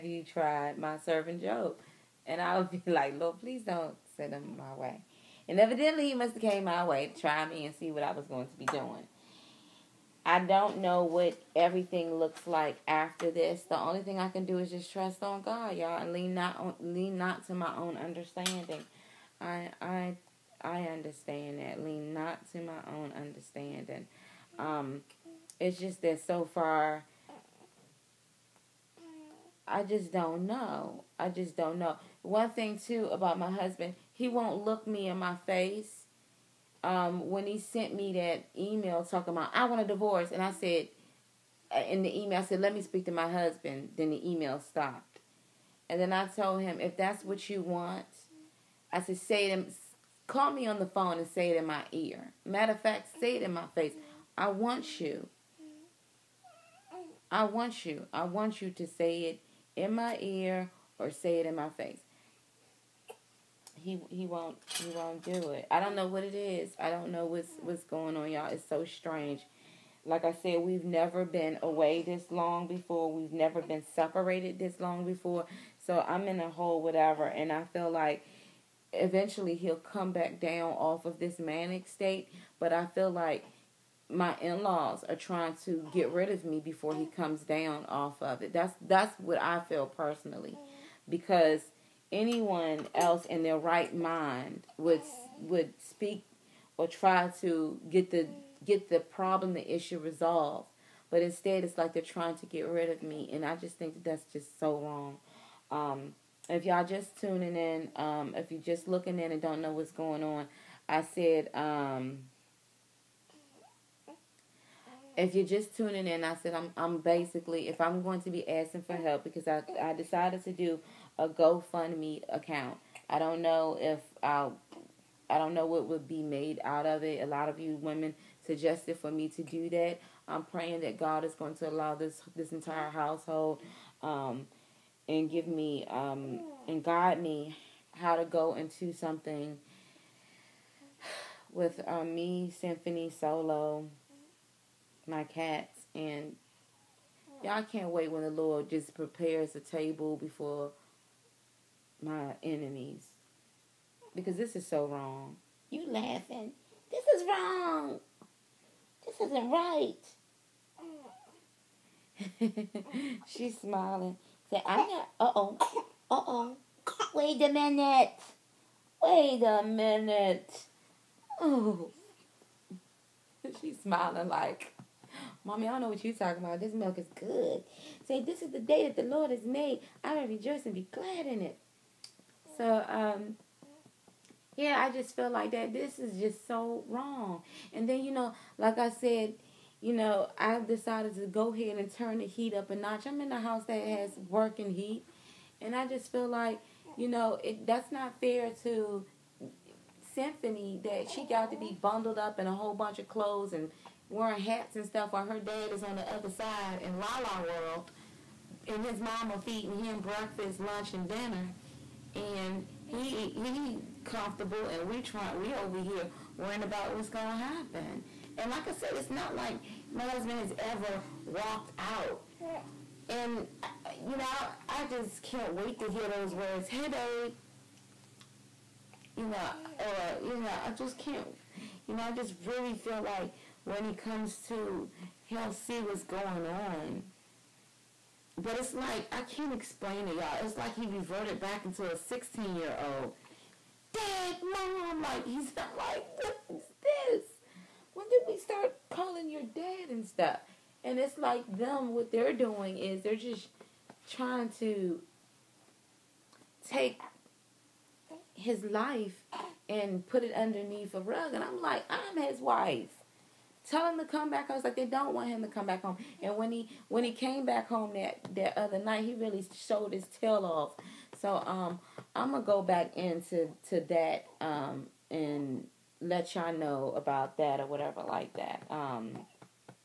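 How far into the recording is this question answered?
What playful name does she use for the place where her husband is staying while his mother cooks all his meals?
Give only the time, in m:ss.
3:26.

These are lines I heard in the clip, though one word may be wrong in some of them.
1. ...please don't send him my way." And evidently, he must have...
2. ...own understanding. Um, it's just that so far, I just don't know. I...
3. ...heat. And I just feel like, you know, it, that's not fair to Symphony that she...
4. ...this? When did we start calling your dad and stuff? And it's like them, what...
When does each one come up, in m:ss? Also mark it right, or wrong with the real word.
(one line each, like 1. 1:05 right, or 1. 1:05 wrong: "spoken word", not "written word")
1. 0:03 right
2. 0:22 right
3. 3:14 right
4. 4:06 right.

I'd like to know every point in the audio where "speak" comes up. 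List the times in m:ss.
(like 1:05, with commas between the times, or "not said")
0:42, 1:35.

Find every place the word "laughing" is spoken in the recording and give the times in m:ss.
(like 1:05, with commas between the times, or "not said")
2:35.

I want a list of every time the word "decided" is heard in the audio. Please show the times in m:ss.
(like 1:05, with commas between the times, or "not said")
1:59, 3:10.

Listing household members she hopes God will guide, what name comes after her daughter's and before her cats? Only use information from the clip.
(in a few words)
Solo.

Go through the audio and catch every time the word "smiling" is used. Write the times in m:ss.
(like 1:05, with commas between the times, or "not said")
2:43, 2:53.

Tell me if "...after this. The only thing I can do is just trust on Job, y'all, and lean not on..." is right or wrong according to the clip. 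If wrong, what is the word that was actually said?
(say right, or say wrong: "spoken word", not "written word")
wrong: "God", not "Job".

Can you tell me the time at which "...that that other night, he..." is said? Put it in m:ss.
4:27.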